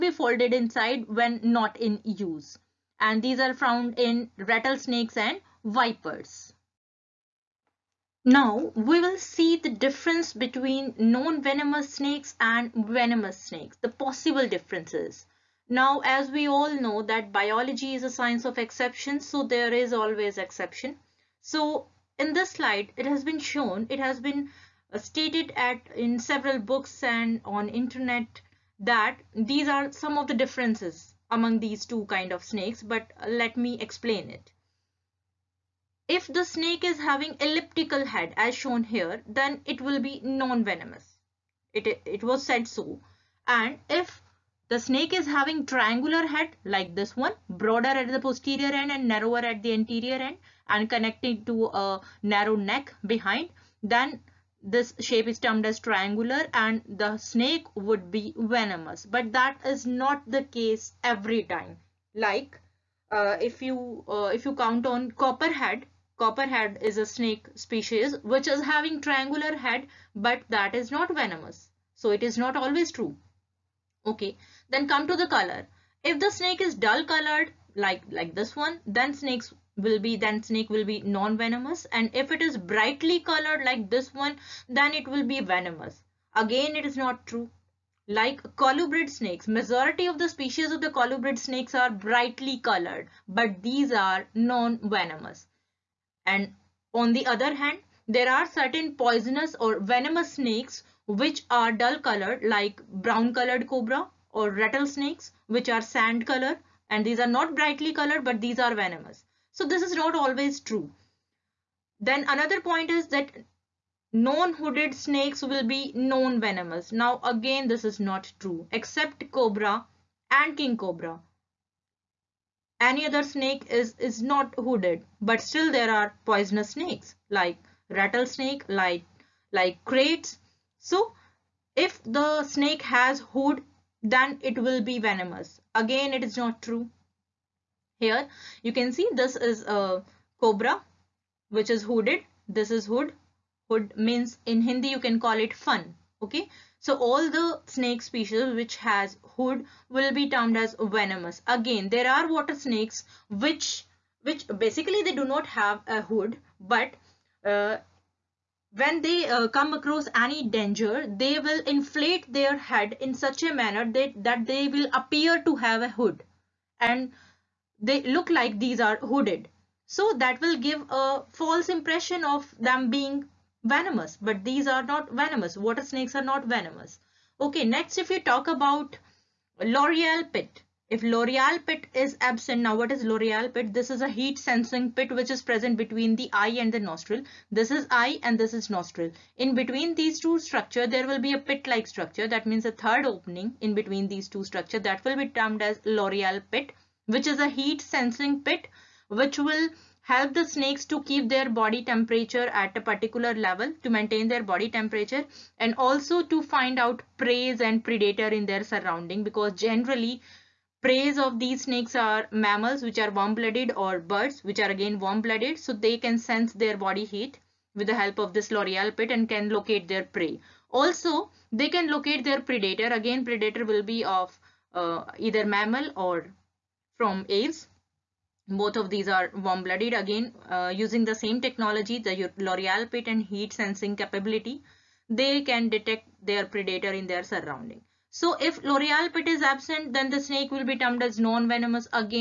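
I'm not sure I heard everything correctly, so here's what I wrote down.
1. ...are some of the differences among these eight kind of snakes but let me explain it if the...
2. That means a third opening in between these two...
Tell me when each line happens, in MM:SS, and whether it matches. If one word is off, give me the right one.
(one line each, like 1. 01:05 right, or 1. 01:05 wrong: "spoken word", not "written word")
1. 00:29 wrong: "two", not "eight"
2. 03:12 right.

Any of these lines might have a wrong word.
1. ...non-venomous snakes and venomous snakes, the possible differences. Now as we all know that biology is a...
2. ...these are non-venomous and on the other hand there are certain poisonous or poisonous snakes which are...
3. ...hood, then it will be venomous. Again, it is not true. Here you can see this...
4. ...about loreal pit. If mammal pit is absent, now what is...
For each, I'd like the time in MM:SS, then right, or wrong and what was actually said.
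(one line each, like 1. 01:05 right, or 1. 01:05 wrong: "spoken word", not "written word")
1. 00:10 right
2. 01:33 wrong: "venomous", not "poisonous"
3. 02:13 right
4. 02:58 wrong: "loreal", not "mammal".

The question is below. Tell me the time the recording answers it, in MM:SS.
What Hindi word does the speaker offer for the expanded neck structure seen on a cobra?
02:25.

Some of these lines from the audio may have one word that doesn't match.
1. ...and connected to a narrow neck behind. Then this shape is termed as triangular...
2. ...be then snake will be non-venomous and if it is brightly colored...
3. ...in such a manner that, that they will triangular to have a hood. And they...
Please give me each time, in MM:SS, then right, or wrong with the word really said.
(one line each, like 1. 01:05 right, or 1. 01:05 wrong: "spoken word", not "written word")
1. 00:50 right
2. 01:19 right
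3. 02:42 wrong: "appear", not "triangular".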